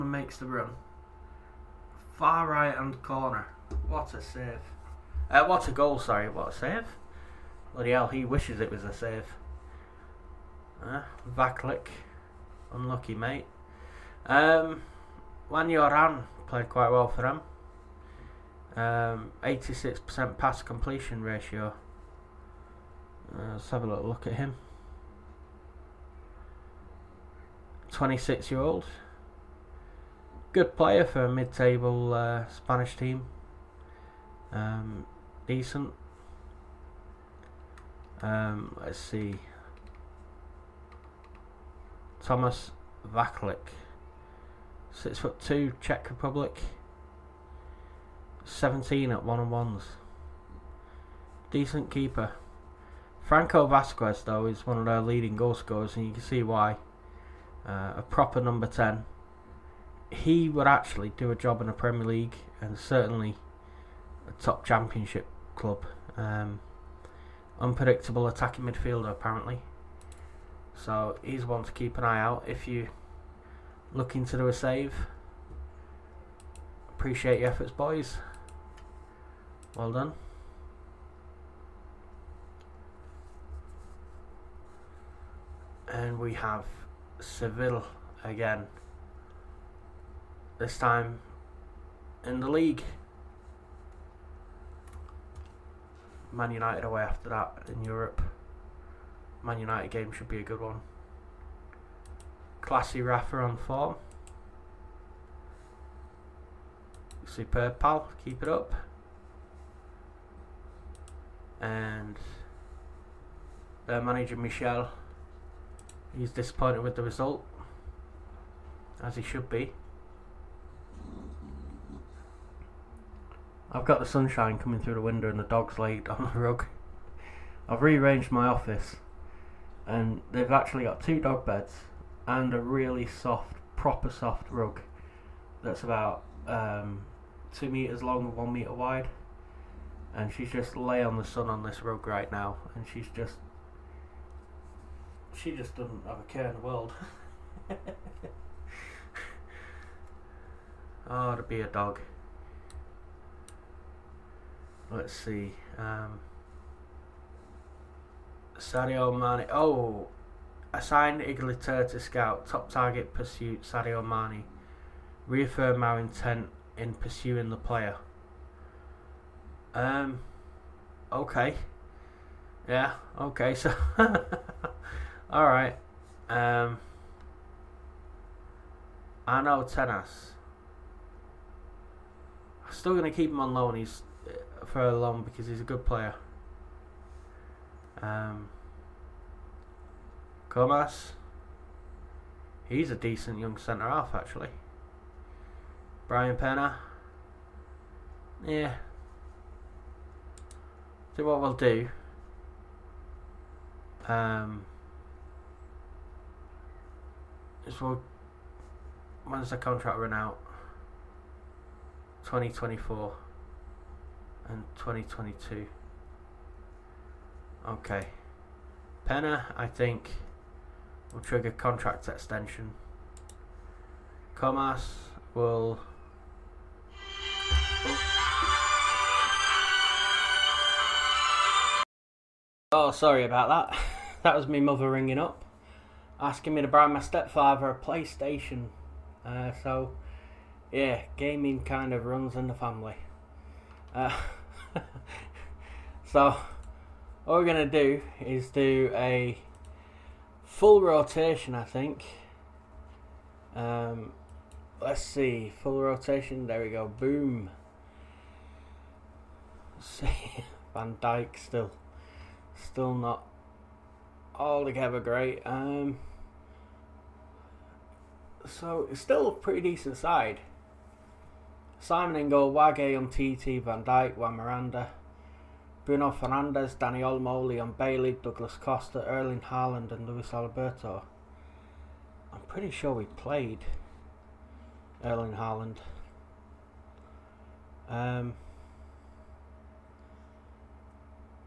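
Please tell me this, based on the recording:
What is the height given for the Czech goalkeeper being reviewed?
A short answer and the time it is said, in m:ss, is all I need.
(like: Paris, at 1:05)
Six foot two, at 0:44.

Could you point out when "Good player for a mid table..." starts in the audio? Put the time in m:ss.
0:30.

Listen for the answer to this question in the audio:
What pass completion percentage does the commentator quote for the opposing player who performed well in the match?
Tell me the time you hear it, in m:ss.
0:19.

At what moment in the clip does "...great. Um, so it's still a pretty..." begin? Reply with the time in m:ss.
4:24.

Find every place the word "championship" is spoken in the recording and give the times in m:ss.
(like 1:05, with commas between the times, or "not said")
1:04.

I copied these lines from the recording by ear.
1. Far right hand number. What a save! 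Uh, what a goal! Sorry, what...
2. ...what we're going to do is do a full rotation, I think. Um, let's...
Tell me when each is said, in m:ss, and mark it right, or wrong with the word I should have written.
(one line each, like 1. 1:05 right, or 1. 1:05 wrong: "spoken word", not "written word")
1. 0:02 wrong: "corner", not "number"
2. 4:07 right.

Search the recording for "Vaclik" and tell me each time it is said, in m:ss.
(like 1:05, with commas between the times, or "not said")
0:11, 0:43.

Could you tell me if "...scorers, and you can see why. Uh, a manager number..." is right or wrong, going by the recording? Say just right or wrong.
wrong.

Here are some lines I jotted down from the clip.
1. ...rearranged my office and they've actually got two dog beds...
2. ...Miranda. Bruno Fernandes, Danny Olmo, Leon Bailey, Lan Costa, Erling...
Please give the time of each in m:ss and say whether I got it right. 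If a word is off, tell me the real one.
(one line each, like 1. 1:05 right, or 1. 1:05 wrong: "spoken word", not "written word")
1. 2:07 right
2. 4:34 wrong: "Douglas", not "Lan".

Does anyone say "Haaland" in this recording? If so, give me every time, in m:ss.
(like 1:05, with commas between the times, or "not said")
4:39, 4:45.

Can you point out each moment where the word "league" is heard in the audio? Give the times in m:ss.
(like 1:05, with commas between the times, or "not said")
1:02, 1:32.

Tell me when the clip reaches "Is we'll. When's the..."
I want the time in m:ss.
3:27.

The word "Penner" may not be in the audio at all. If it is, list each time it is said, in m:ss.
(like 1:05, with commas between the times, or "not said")
3:16, 3:39.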